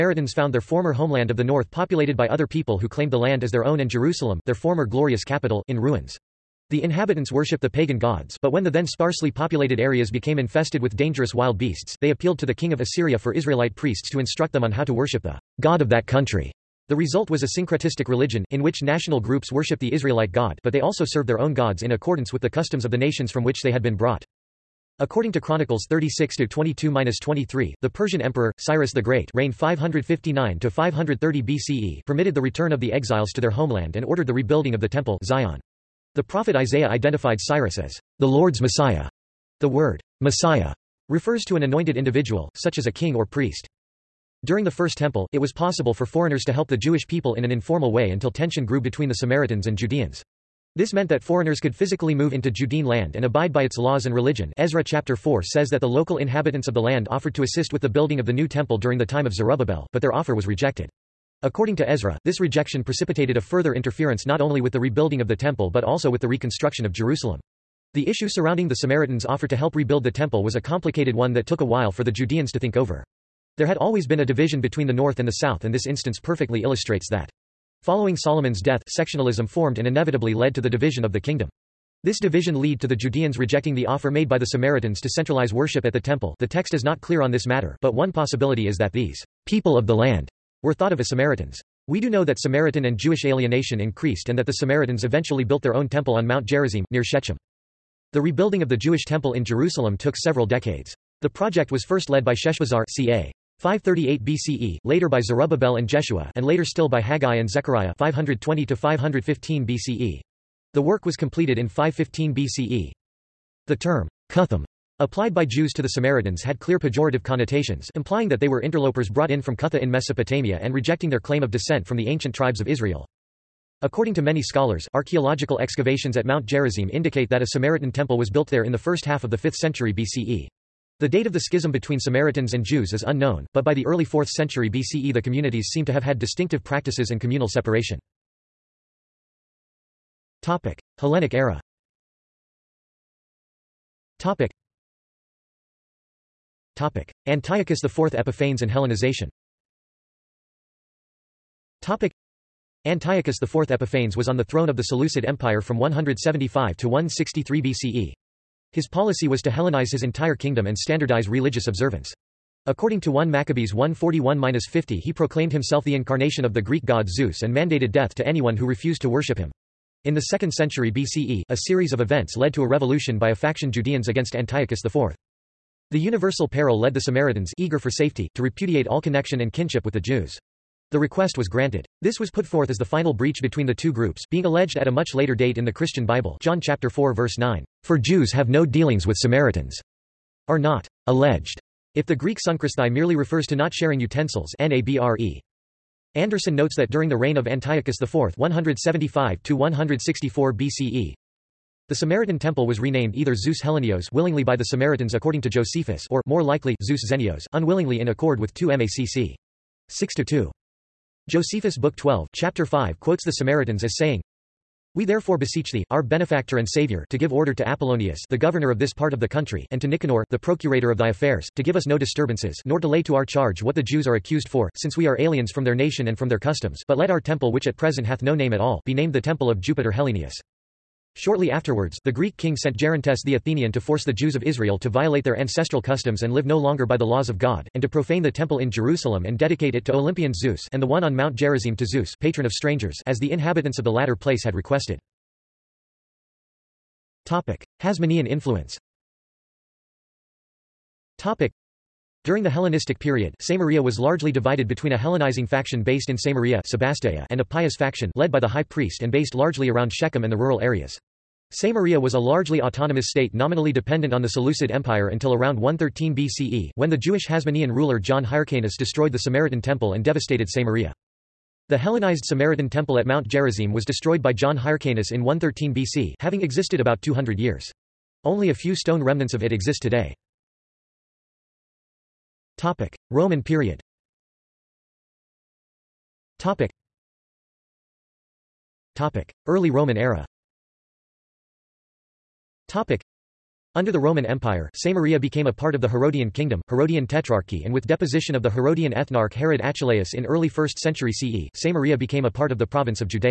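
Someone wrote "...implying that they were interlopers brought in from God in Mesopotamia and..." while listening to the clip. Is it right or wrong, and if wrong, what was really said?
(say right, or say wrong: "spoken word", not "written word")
wrong: "Cutha", not "God".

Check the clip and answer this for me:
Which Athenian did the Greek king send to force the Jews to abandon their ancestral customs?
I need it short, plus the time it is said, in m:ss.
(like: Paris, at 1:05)
Gerontes, at 3:52.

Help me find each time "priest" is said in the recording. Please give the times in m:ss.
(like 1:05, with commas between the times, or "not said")
0:13, 0:43, 4:18.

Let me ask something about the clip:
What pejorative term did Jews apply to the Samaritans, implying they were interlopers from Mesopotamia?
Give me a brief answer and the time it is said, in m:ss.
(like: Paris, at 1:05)
Cuthim, at 1:54.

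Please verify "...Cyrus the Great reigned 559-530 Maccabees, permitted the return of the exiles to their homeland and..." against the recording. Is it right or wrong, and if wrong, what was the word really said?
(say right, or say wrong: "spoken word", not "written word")
wrong: "BCE", not "Maccabees".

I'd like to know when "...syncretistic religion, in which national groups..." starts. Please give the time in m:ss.
0:17.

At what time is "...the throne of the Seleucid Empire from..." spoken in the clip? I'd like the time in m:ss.
2:34.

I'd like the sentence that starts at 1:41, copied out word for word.
The project was first led by Sheshbazzar ca.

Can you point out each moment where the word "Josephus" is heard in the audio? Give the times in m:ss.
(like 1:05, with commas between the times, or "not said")
3:25, 3:31.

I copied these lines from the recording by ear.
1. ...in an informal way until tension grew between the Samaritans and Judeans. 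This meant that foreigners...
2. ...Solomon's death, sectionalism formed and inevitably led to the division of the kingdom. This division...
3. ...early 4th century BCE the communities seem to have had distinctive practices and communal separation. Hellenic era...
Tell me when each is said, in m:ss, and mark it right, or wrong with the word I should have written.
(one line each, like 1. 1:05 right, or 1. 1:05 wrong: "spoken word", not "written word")
1. 0:47 right
2. 1:18 right
3. 2:13 right.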